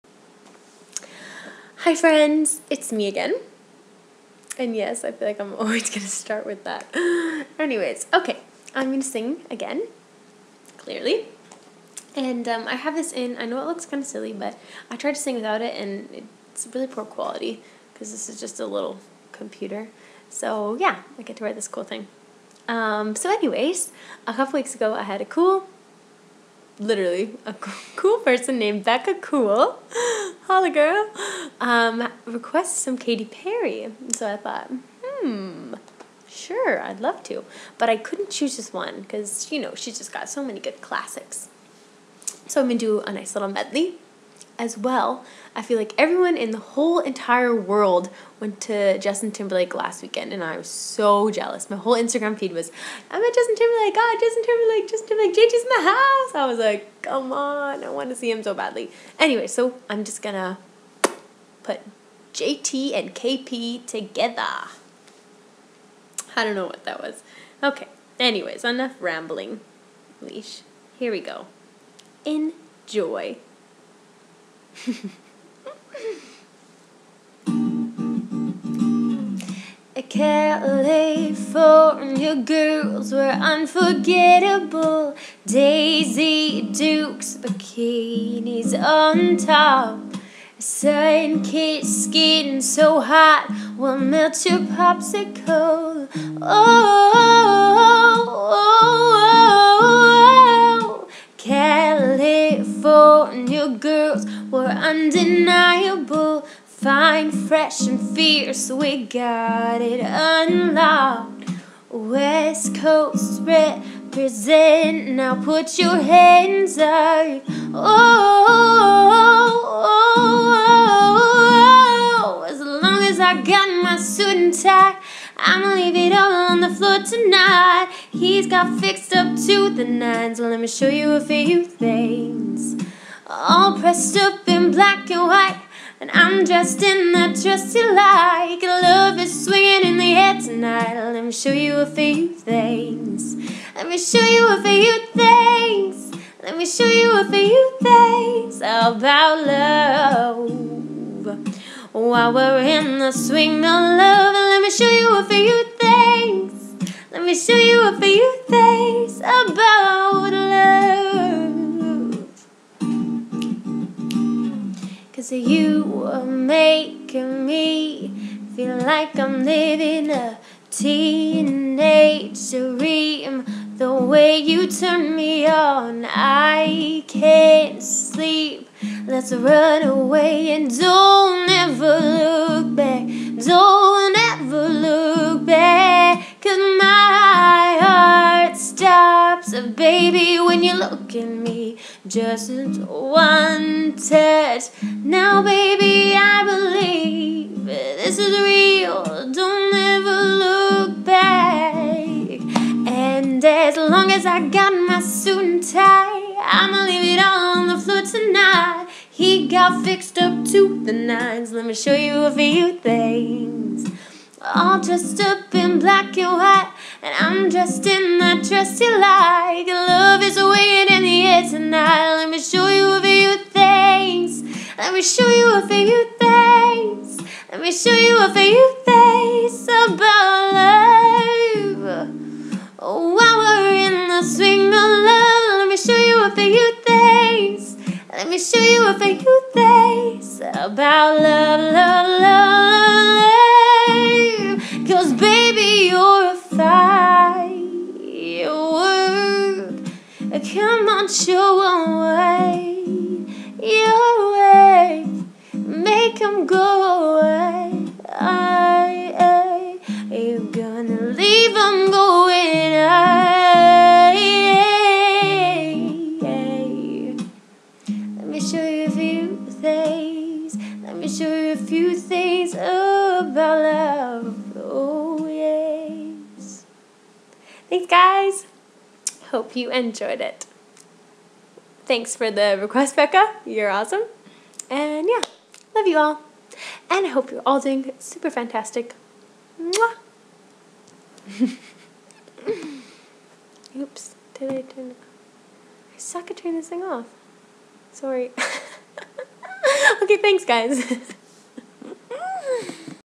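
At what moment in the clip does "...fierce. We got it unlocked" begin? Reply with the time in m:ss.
1:47.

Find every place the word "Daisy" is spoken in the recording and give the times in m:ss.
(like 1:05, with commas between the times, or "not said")
1:25.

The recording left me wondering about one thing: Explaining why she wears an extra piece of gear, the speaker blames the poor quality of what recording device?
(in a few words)
a little computer.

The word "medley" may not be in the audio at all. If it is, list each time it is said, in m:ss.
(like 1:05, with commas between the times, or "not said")
0:43.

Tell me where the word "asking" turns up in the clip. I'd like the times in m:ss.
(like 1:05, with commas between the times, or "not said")
not said.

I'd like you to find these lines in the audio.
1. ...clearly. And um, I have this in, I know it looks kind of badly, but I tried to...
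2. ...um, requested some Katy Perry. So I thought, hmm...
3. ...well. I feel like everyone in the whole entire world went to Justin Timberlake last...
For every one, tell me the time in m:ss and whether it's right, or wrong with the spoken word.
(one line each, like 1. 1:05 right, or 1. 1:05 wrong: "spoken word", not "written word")
1. 0:10 wrong: "silly", not "badly"
2. 0:31 right
3. 0:44 right.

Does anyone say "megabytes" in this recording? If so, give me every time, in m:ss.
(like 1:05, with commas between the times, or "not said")
not said.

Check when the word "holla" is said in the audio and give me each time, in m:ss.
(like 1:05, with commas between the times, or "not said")
0:30.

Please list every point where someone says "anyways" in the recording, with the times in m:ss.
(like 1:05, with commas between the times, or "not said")
0:07, 0:23, 0:59, 1:08.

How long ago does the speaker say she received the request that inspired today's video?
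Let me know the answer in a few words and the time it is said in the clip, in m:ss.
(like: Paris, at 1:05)
a couple weeks ago, at 0:24.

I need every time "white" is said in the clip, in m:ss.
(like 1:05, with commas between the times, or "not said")
2:15, 3:36.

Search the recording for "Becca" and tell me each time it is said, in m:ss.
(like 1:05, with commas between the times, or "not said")
0:28, 4:42.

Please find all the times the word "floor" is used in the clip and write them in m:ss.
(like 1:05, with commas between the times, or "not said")
2:06, 3:27.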